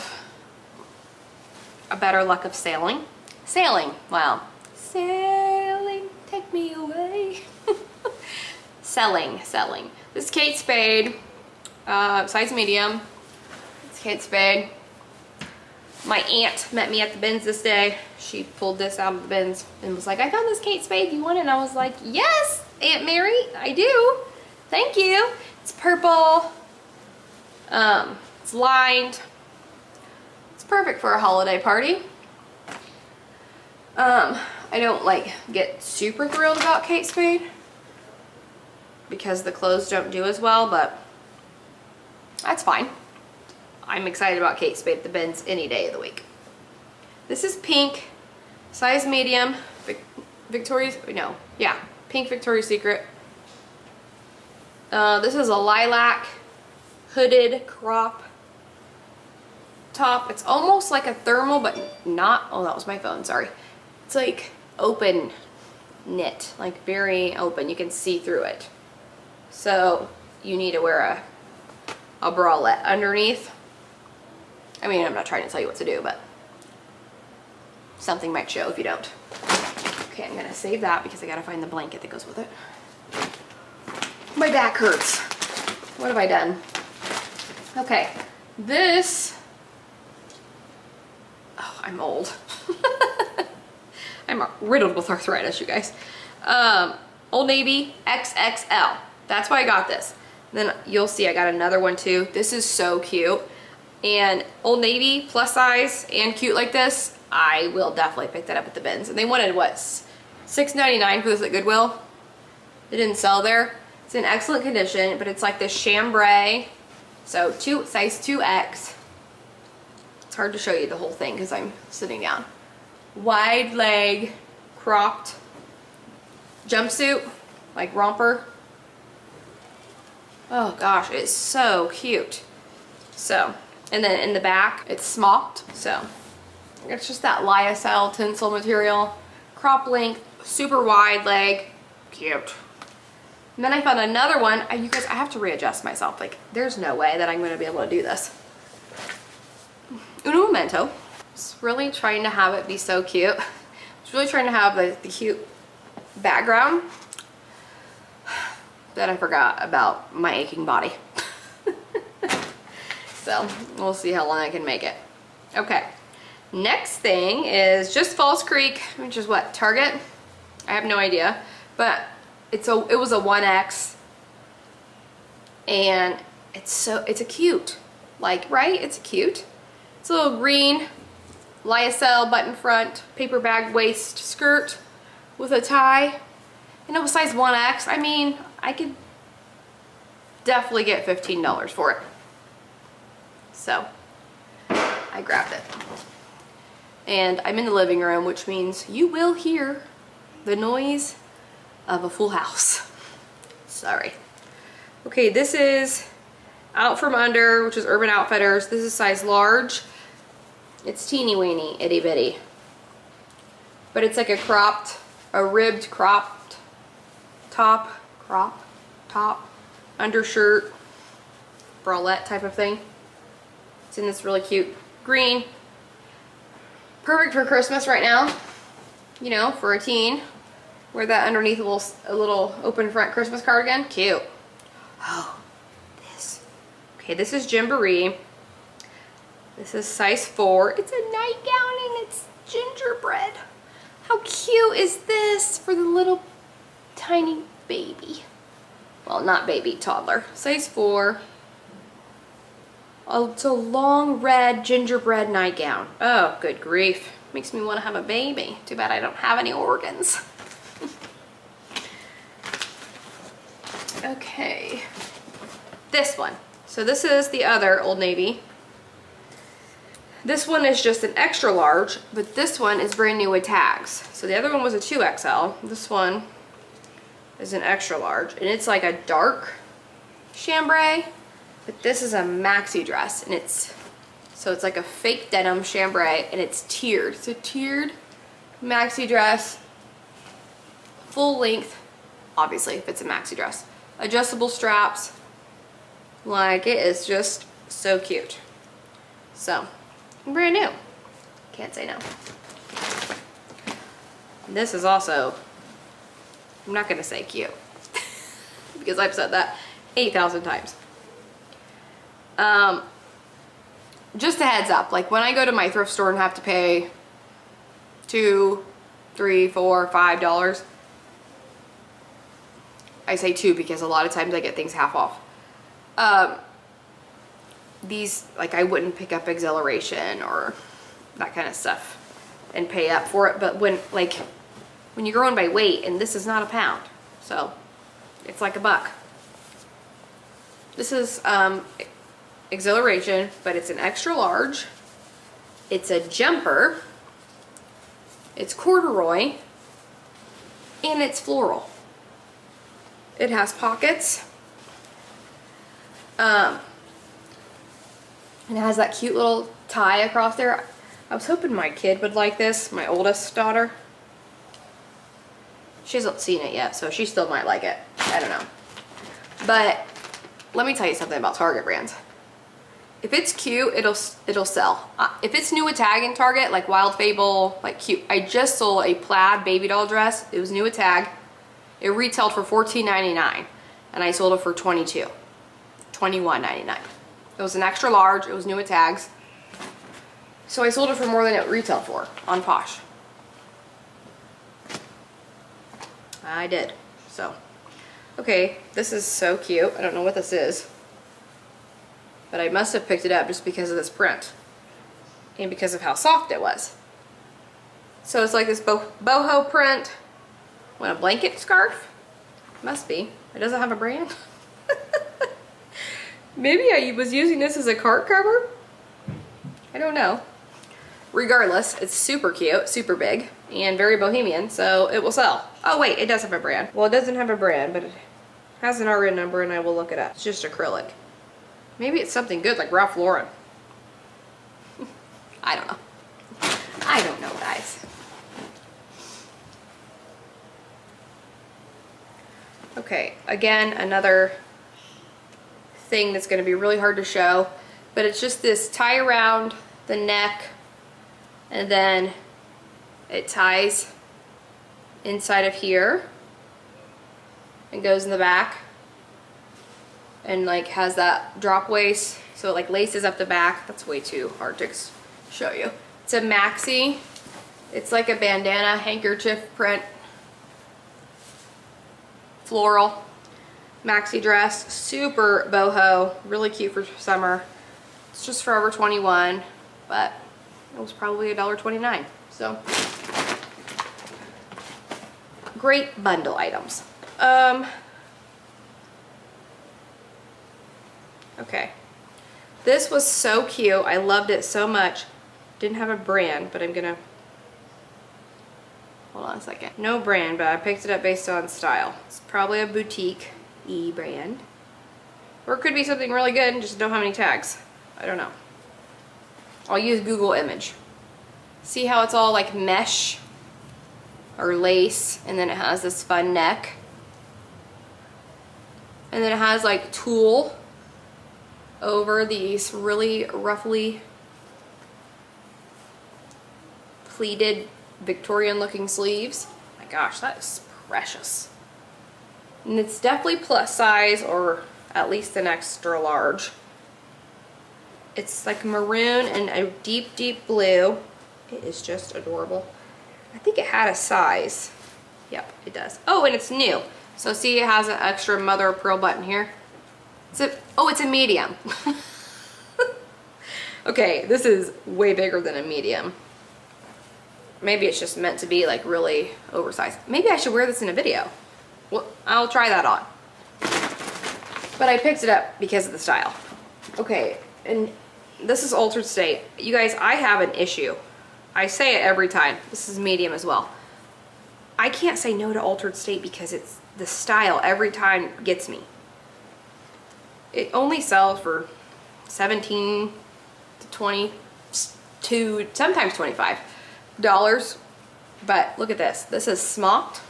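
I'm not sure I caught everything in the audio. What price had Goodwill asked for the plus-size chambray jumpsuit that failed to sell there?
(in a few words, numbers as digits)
$6.99.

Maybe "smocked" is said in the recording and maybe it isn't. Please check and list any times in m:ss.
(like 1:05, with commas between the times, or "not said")
2:15, 9:49.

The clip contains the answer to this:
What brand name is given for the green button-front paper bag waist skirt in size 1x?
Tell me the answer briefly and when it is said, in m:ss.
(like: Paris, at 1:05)
False Creek, at 2:48.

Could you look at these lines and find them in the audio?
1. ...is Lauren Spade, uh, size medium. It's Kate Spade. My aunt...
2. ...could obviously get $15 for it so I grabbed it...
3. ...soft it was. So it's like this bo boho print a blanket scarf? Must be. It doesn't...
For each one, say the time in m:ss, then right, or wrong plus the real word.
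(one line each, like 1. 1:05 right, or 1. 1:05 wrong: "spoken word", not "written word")
1. 0:10 wrong: "Kate", not "Lauren"
2. 3:08 wrong: "definitely", not "obviously"
3. 6:45 right.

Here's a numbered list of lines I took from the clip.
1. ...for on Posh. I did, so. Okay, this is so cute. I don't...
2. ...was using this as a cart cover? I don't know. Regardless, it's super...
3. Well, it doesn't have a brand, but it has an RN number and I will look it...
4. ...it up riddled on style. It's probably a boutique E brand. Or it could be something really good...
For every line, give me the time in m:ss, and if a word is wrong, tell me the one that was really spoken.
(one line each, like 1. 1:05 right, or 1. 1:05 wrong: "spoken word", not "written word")
1. 6:31 right
2. 6:56 right
3. 7:06 right
4. 8:20 wrong: "based", not "riddled".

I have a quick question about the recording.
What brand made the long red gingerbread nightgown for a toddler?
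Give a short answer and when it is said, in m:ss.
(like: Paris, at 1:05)
Gymboree, at 3:57.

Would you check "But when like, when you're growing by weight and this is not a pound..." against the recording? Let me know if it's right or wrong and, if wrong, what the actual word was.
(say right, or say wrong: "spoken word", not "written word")
right.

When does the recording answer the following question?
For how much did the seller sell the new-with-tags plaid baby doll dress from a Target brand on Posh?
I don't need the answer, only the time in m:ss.
6:25.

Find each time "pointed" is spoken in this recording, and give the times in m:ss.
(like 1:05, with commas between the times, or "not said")
not said.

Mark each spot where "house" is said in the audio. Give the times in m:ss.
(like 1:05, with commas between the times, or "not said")
3:22.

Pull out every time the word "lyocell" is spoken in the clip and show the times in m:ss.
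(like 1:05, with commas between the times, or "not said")
2:17, 3:01.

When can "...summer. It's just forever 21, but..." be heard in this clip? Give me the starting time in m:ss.
7:56.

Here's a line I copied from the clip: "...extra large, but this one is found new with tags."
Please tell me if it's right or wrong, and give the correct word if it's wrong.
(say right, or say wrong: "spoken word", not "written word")
wrong: "brand", not "found".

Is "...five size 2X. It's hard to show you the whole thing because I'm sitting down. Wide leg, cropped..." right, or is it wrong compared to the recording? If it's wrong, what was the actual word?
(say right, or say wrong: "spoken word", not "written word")
wrong: "two", not "five".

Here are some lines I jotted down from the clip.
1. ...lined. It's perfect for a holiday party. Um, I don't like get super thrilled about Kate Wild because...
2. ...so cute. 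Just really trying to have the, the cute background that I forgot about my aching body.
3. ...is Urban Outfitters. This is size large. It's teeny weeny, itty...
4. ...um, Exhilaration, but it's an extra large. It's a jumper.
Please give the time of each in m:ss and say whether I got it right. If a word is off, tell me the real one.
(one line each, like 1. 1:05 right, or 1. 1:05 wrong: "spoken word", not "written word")
1. 0:28 wrong: "Spade", not "Wild"
2. 2:32 right
3. 3:27 right
4. 5:41 right.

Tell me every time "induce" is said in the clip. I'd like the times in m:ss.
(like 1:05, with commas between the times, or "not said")
not said.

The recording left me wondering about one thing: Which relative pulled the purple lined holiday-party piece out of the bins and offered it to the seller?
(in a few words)
Aunt Mary.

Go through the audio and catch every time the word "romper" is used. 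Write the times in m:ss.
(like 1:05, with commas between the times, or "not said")
2:07.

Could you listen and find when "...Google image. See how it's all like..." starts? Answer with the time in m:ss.
8:30.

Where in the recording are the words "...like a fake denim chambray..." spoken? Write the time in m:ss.
4:44.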